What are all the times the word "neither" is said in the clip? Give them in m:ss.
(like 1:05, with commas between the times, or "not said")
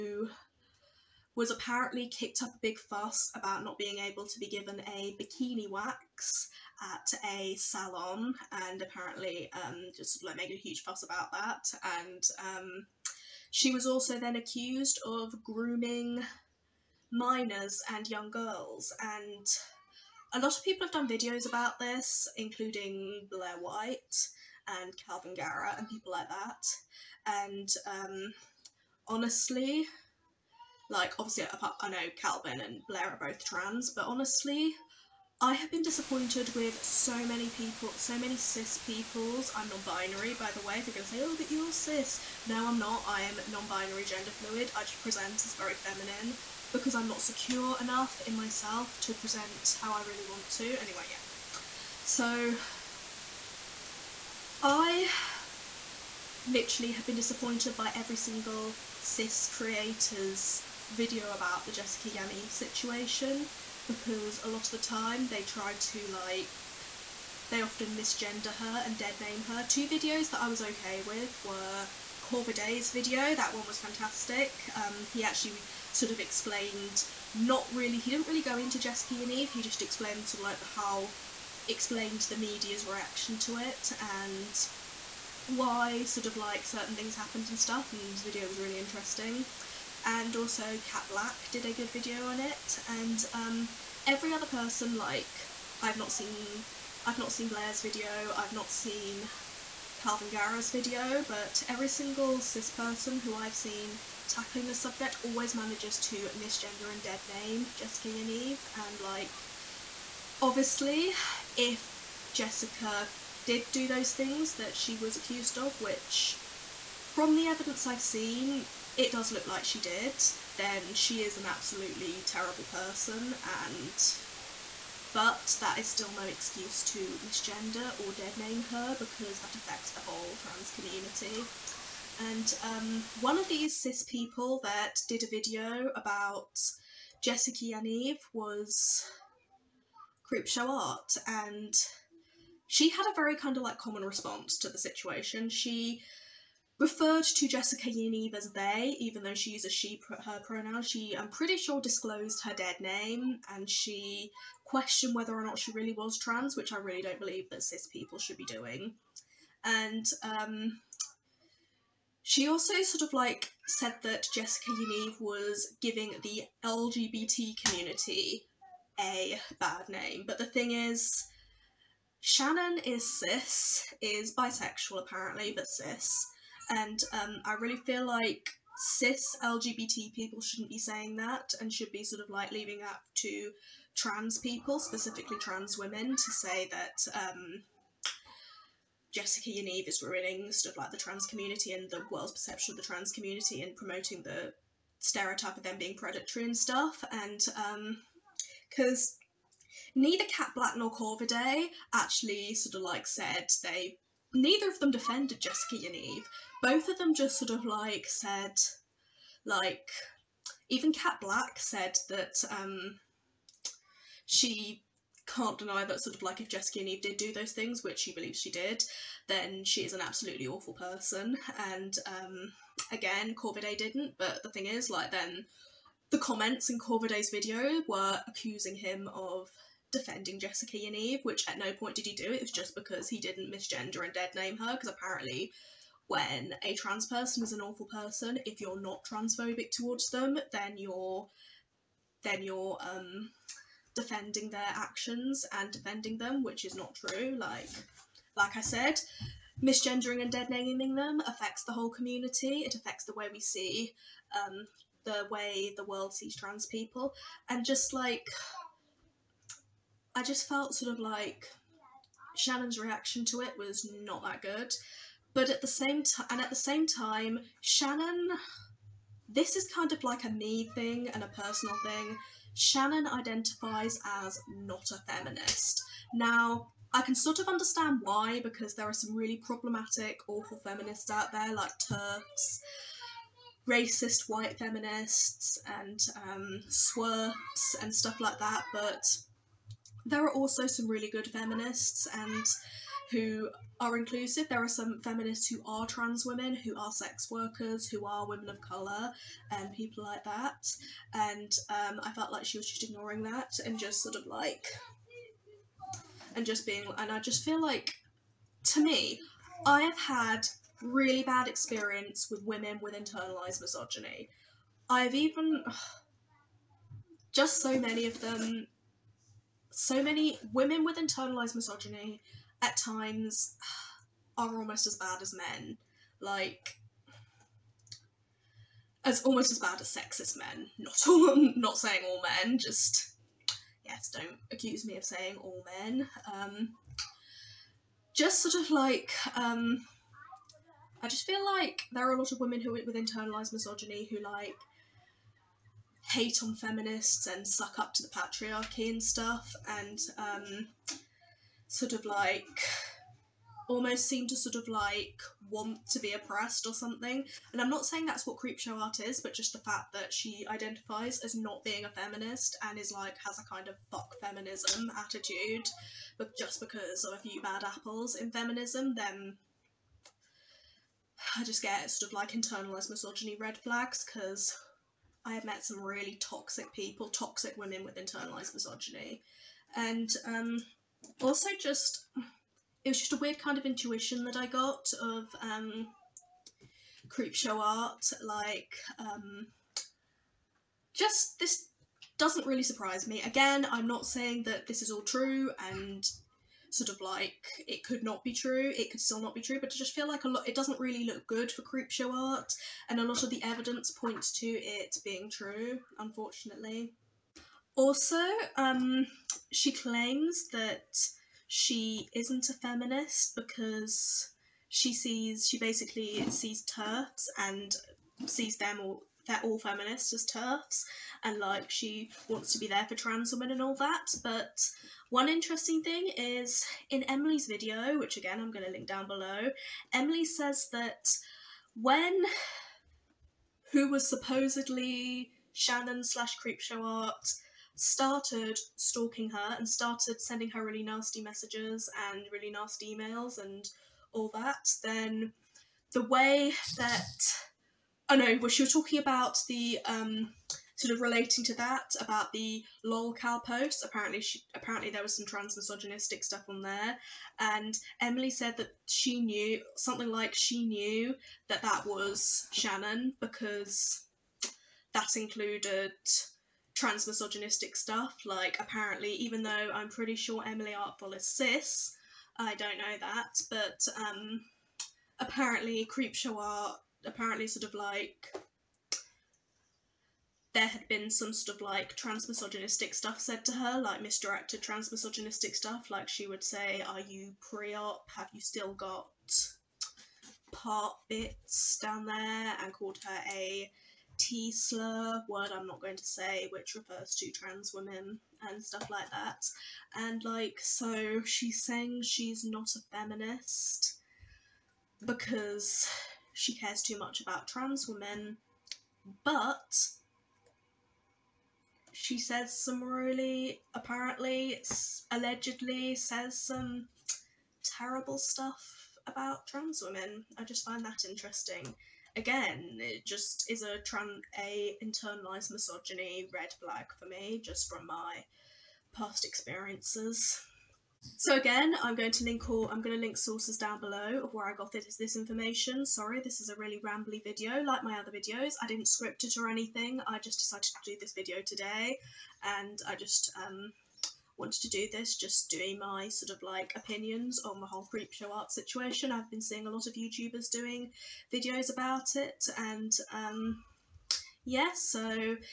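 3:19, 3:24.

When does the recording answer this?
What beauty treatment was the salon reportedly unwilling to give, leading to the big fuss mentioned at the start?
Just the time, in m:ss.
0:05.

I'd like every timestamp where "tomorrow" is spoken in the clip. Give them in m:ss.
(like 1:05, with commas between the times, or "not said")
not said.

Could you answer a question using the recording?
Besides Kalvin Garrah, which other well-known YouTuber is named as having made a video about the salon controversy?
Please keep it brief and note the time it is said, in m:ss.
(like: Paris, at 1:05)
Blair White, at 0:23.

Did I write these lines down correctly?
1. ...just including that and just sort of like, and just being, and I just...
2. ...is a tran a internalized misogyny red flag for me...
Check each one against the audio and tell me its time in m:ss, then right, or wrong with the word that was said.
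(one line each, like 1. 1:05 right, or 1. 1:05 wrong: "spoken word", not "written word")
1. 5:02 wrong: "ignoring", not "including"
2. 8:43 right.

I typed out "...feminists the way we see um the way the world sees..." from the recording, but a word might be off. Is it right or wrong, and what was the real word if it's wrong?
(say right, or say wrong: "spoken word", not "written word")
wrong: "affects", not "feminists".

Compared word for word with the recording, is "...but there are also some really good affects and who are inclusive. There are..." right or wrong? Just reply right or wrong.
wrong.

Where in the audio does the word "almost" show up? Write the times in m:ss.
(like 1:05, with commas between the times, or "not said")
5:24, 5:29, 5:53.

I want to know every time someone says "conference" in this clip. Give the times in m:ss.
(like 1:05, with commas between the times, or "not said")
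not said.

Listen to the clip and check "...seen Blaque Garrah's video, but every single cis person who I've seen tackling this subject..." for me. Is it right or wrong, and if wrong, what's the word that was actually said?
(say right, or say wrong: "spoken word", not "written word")
wrong: "Kalvin", not "Blaque".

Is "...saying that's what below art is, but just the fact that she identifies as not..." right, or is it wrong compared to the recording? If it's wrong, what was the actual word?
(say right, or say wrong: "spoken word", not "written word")
wrong: "creepshow", not "below".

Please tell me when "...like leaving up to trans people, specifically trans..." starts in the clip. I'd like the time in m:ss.
3:02.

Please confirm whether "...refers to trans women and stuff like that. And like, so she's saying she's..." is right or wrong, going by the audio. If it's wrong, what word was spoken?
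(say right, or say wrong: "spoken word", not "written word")
right.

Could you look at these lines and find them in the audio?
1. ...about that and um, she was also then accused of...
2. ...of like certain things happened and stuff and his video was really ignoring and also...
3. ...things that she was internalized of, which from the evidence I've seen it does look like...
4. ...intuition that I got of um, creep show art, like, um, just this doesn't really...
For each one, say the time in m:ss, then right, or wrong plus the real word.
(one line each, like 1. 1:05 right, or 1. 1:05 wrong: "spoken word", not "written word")
1. 0:11 right
2. 1:26 wrong: "interesting", not "ignoring"
3. 1:54 wrong: "accused", not "internalized"
4. 6:23 right.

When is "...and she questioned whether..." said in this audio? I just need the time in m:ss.
2:33.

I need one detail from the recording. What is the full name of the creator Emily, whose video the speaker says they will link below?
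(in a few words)
Emily Artful.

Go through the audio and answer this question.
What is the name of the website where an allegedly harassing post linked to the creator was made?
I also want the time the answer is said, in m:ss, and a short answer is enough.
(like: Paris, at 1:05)
lolcow, at 7:32.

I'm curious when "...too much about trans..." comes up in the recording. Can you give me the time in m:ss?
8:26.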